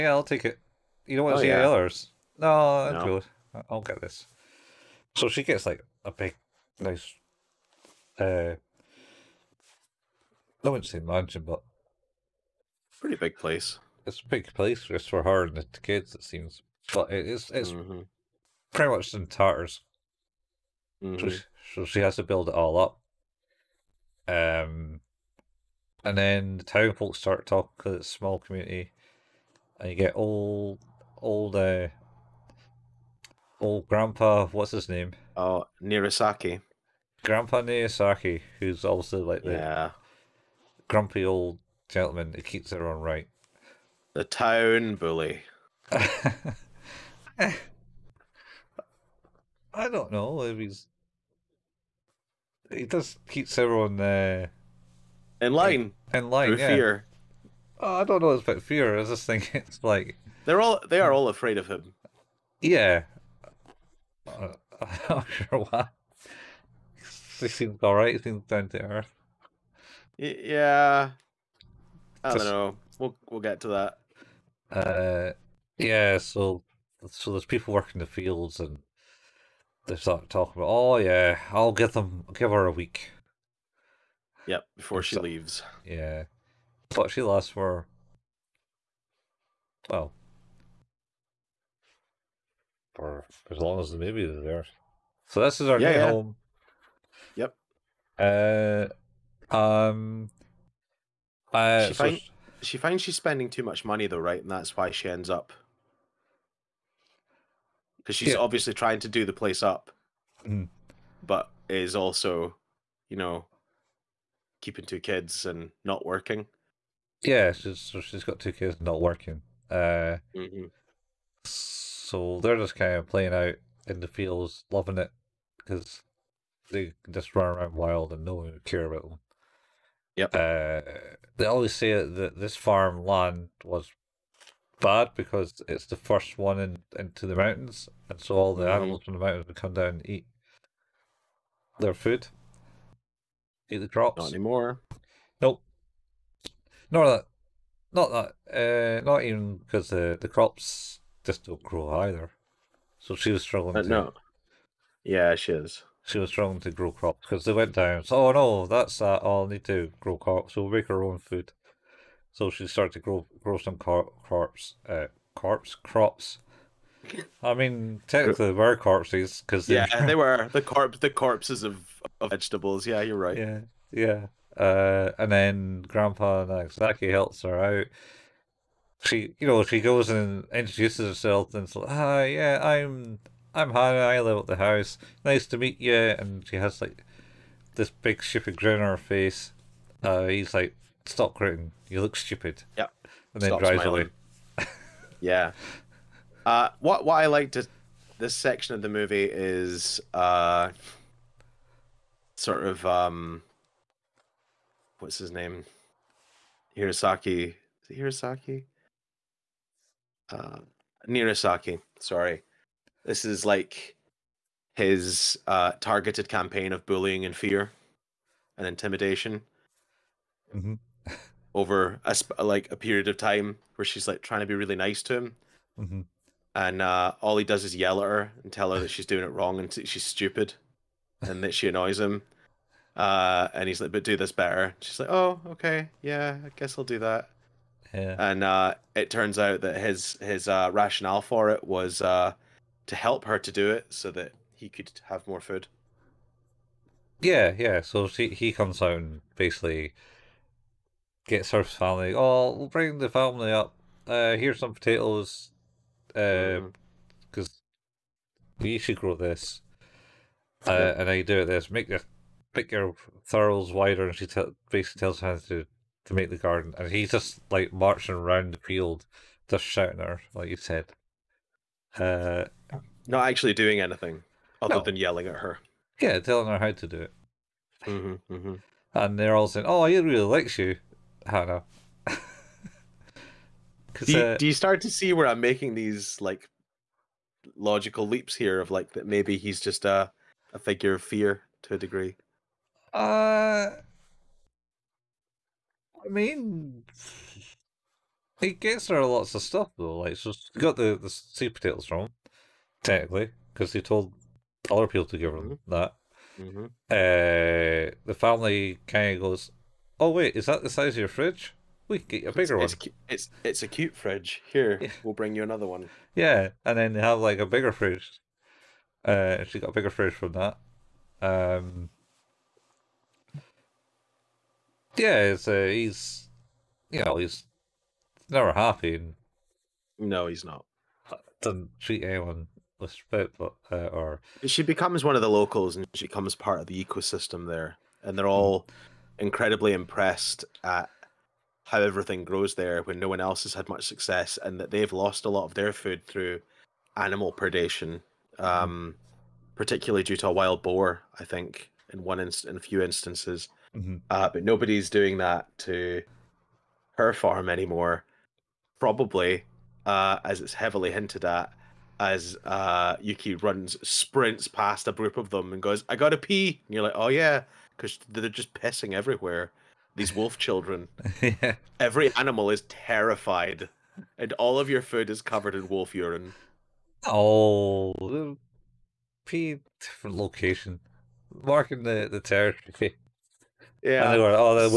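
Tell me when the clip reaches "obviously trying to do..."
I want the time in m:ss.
1:48.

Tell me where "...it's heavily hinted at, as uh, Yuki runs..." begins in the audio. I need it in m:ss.
6:00.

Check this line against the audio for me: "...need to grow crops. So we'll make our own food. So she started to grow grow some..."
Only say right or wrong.
right.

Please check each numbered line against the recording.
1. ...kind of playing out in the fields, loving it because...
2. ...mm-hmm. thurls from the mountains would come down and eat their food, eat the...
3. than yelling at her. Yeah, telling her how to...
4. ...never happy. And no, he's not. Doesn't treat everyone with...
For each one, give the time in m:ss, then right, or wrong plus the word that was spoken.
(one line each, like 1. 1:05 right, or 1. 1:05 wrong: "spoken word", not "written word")
1. 2:02 right
2. 2:18 wrong: "animals", not "thurls"
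3. 4:34 right
4. 5:28 wrong: "anyone", not "everyone".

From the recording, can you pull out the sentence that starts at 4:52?
Uh, I mean, he gets her lots of stuff though.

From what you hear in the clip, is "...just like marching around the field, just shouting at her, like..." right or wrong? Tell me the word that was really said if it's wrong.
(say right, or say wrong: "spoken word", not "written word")
right.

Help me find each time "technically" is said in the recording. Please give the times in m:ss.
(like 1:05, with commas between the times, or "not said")
2:48, 5:02.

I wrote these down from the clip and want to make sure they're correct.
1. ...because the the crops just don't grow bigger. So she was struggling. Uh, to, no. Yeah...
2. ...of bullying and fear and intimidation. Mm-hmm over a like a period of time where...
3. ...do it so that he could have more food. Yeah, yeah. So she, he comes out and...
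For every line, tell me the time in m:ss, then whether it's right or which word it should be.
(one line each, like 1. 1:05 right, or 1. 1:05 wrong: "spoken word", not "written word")
1. 2:29 wrong: "either", not "bigger"
2. 3:36 right
3. 4:03 right.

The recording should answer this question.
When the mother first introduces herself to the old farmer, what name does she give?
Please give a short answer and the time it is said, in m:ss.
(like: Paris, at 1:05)
Hana, at 3:03.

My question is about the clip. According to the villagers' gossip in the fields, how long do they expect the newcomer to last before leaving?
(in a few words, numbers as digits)
a week.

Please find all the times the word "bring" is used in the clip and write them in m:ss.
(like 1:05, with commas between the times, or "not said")
4:12, 5:15.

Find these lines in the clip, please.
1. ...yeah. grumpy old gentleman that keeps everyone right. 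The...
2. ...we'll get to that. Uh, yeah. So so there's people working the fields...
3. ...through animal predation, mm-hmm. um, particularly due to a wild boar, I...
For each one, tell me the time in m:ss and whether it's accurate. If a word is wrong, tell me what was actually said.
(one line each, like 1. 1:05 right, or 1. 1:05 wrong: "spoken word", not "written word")
1. 0:39 right
2. 1:13 right
3. 5:46 right.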